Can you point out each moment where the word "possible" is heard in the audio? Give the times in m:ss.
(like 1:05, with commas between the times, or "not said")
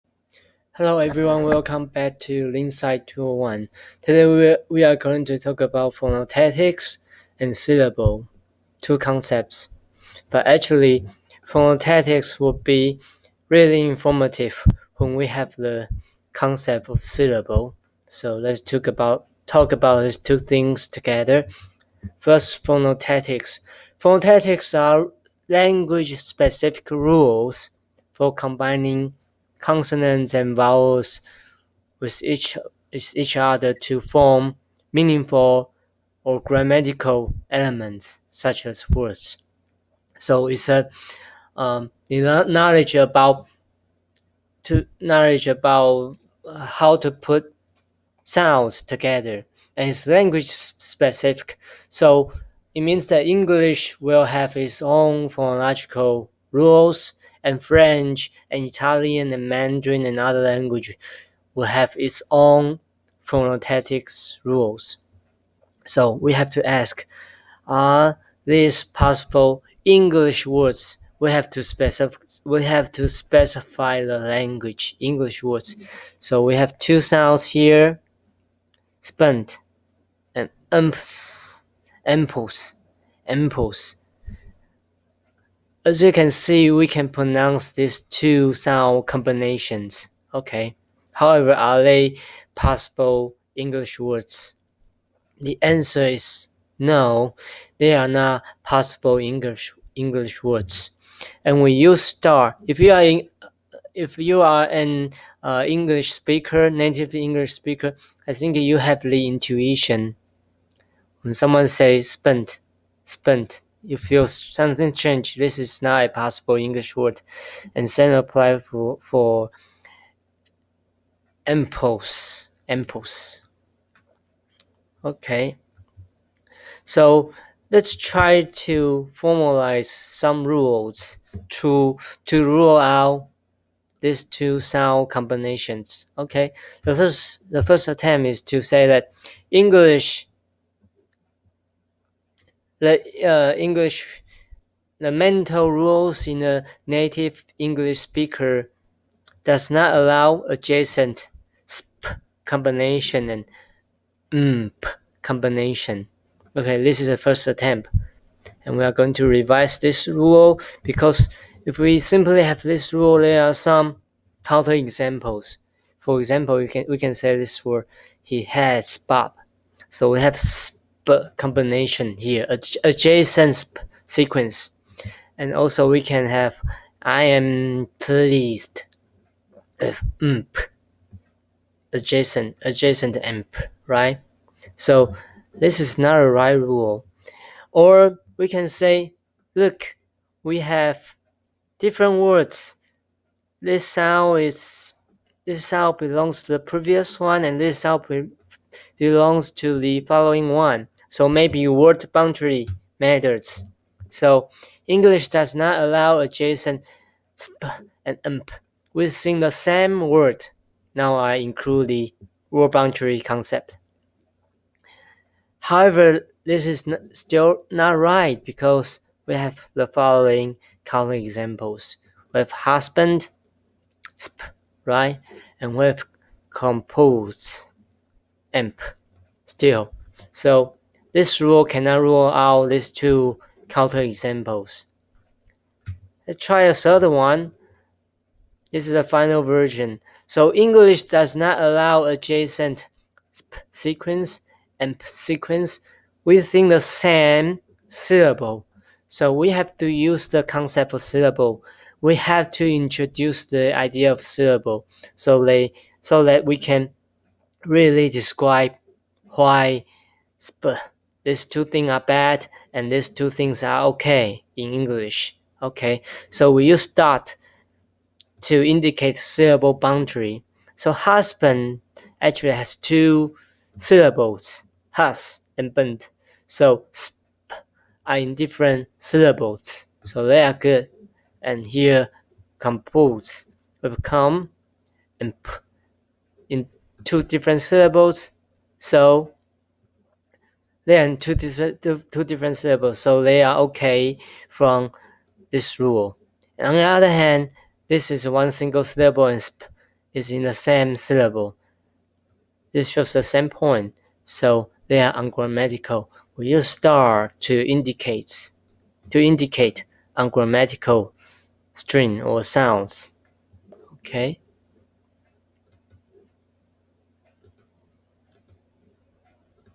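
1:08, 1:32, 1:38, 1:56.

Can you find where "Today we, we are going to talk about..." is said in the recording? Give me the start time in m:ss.
0:04.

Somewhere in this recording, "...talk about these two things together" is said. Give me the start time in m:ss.
0:19.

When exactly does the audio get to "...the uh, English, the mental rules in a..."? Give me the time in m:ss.
2:22.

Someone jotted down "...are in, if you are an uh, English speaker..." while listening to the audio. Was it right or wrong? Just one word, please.
right.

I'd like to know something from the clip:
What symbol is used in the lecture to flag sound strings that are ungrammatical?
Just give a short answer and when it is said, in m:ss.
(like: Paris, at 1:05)
star, at 5:06.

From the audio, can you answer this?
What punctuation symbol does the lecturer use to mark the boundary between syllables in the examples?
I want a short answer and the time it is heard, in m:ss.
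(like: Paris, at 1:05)
dot, at 4:26.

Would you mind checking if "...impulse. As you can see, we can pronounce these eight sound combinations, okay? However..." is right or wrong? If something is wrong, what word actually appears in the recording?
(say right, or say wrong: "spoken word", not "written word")
wrong: "two", not "eight".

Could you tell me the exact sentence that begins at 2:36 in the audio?
Okay, this is the first attempt.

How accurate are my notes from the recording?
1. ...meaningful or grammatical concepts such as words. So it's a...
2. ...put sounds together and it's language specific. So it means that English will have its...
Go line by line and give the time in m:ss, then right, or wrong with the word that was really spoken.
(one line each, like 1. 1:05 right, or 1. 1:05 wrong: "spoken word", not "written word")
1. 0:34 wrong: "elements", not "concepts"
2. 0:47 right.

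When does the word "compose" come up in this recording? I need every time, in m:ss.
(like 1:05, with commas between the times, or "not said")
3:46, 4:42.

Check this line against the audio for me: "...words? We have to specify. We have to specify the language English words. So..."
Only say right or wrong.
right.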